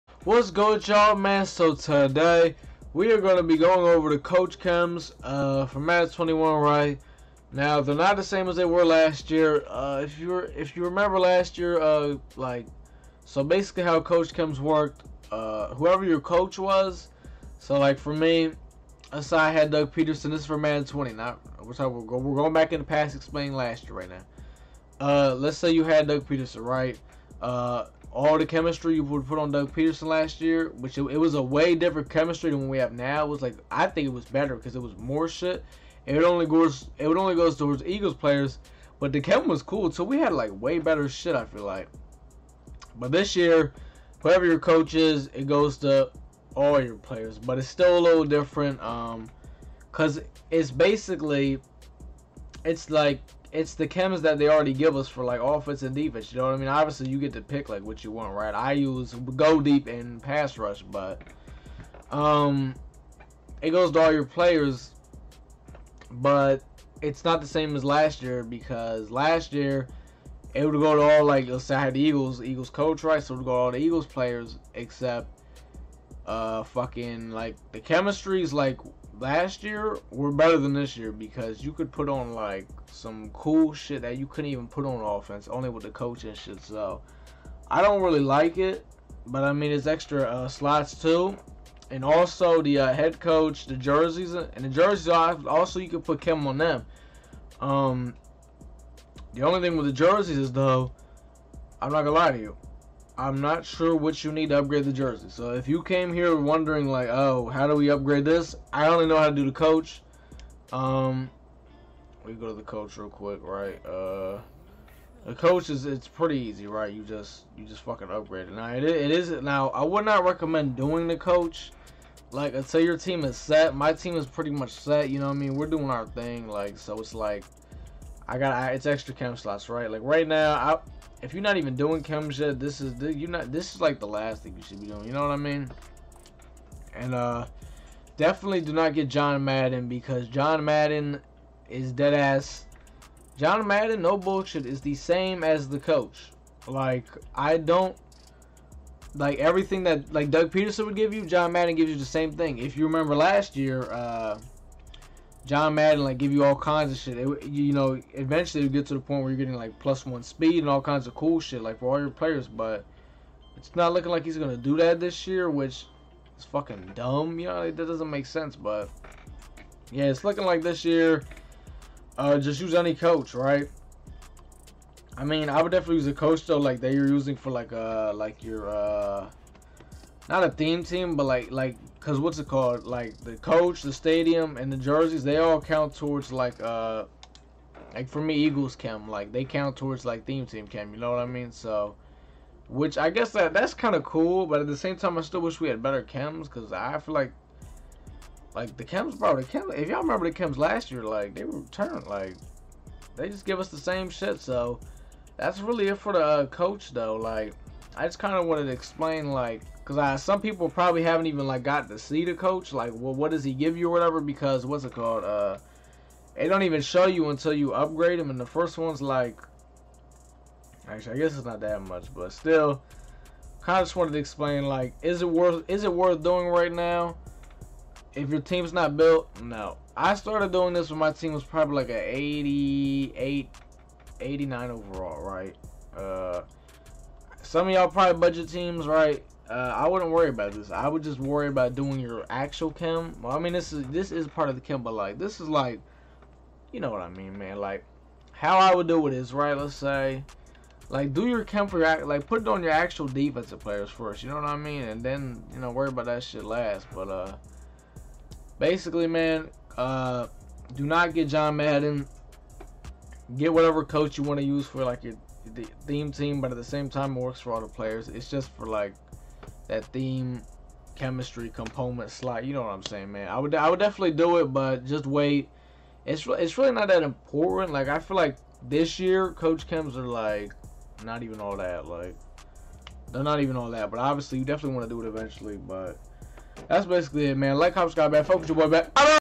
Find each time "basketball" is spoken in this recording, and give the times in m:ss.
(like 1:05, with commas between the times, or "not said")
not said.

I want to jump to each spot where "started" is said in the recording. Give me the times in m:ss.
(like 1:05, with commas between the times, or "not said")
3:50.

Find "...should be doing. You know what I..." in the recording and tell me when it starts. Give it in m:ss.
2:14.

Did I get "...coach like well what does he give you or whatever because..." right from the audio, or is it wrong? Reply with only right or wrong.
right.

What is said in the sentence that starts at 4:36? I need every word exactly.
It's it's really not that important.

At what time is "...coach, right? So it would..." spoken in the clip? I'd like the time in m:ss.
1:12.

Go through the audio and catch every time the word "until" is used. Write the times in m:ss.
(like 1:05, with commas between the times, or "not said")
2:02, 3:37.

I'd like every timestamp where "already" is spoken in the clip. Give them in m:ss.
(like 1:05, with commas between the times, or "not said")
0:54.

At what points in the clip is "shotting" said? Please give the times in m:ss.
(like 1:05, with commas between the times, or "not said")
not said.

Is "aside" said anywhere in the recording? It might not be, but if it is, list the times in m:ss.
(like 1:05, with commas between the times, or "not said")
0:19.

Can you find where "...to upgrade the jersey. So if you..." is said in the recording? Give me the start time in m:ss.
1:44.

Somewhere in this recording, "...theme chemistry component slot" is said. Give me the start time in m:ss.
4:29.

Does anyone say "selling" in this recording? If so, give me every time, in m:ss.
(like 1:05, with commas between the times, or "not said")
not said.